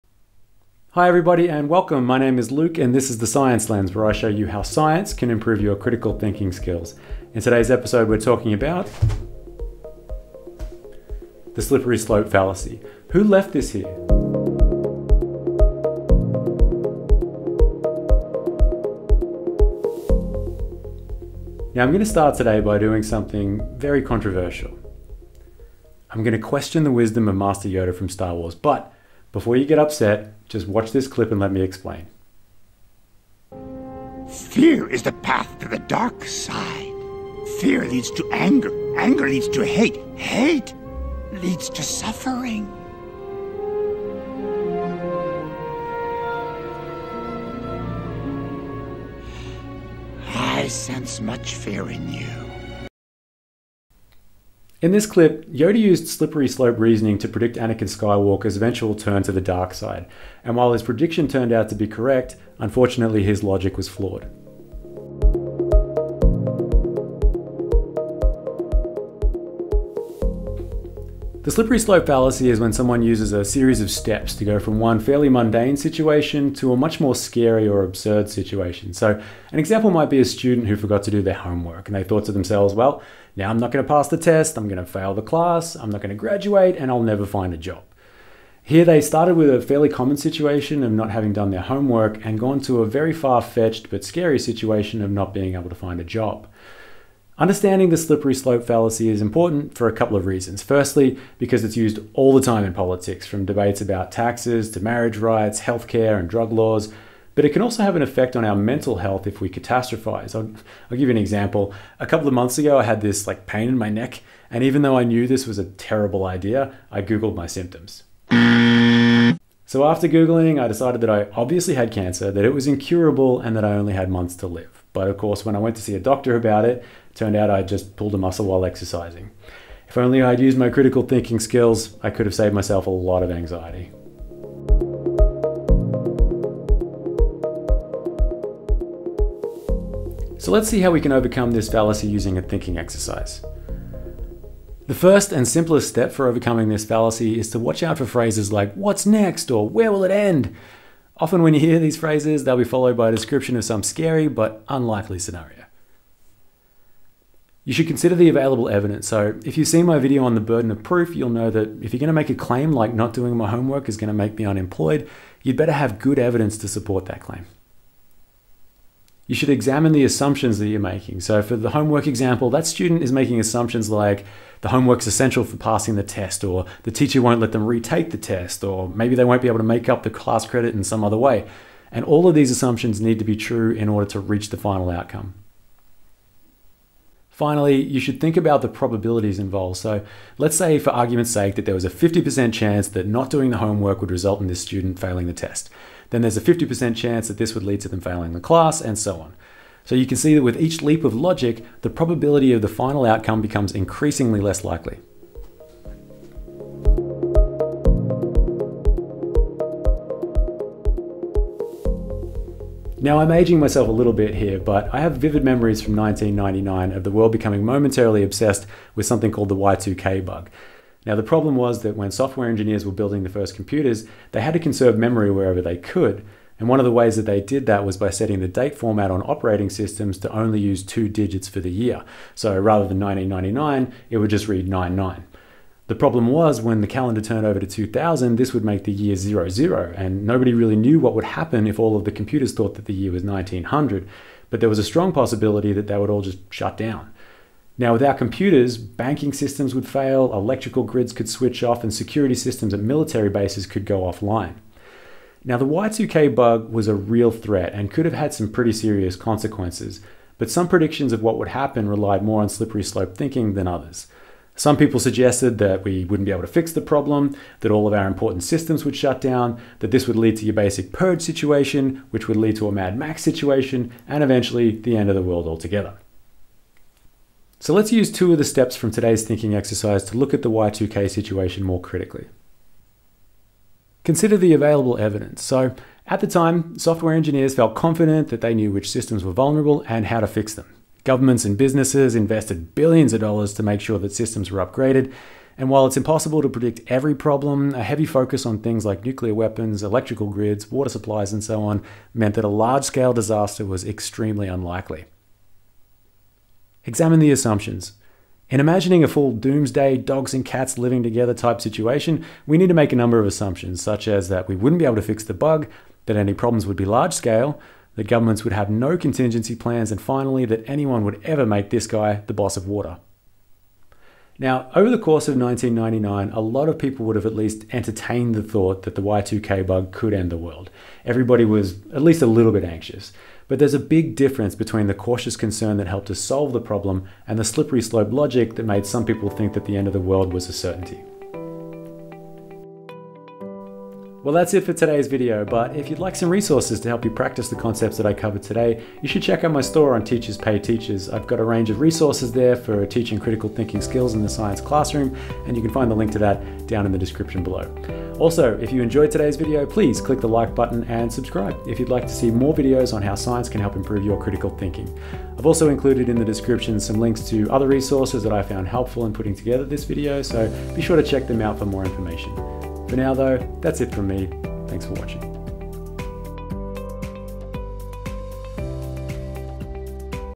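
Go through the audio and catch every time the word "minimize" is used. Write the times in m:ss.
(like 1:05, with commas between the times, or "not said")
not said.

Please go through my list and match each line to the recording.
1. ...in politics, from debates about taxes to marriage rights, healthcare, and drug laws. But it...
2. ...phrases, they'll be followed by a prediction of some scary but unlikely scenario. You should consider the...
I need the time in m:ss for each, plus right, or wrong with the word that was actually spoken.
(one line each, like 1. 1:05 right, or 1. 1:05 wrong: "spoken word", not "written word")
1. 1:42 right
2. 2:31 wrong: "description", not "prediction".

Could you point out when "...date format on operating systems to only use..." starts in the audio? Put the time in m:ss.
3:48.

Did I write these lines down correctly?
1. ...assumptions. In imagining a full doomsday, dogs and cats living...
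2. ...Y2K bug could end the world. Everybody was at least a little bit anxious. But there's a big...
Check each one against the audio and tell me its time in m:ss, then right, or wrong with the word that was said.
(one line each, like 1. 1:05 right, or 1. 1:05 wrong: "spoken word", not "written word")
1. 5:07 right
2. 5:29 right.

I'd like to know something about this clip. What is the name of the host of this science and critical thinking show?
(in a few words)
Luke.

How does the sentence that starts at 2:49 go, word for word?
You should examine the assumptions that you're making.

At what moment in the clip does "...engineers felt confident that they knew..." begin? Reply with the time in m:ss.
4:47.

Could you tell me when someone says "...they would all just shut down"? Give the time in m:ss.
4:05.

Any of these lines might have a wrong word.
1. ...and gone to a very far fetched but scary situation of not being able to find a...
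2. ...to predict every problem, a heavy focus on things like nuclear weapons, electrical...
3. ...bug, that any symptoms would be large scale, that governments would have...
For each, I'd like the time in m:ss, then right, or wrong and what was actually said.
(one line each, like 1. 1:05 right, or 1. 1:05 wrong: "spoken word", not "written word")
1. 1:32 right
2. 4:56 right
3. 5:15 wrong: "problems", not "symptoms".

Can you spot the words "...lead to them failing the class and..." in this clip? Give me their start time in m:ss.
3:17.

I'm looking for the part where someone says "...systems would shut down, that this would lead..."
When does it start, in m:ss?
4:28.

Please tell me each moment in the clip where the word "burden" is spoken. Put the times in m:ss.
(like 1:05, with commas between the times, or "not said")
2:40.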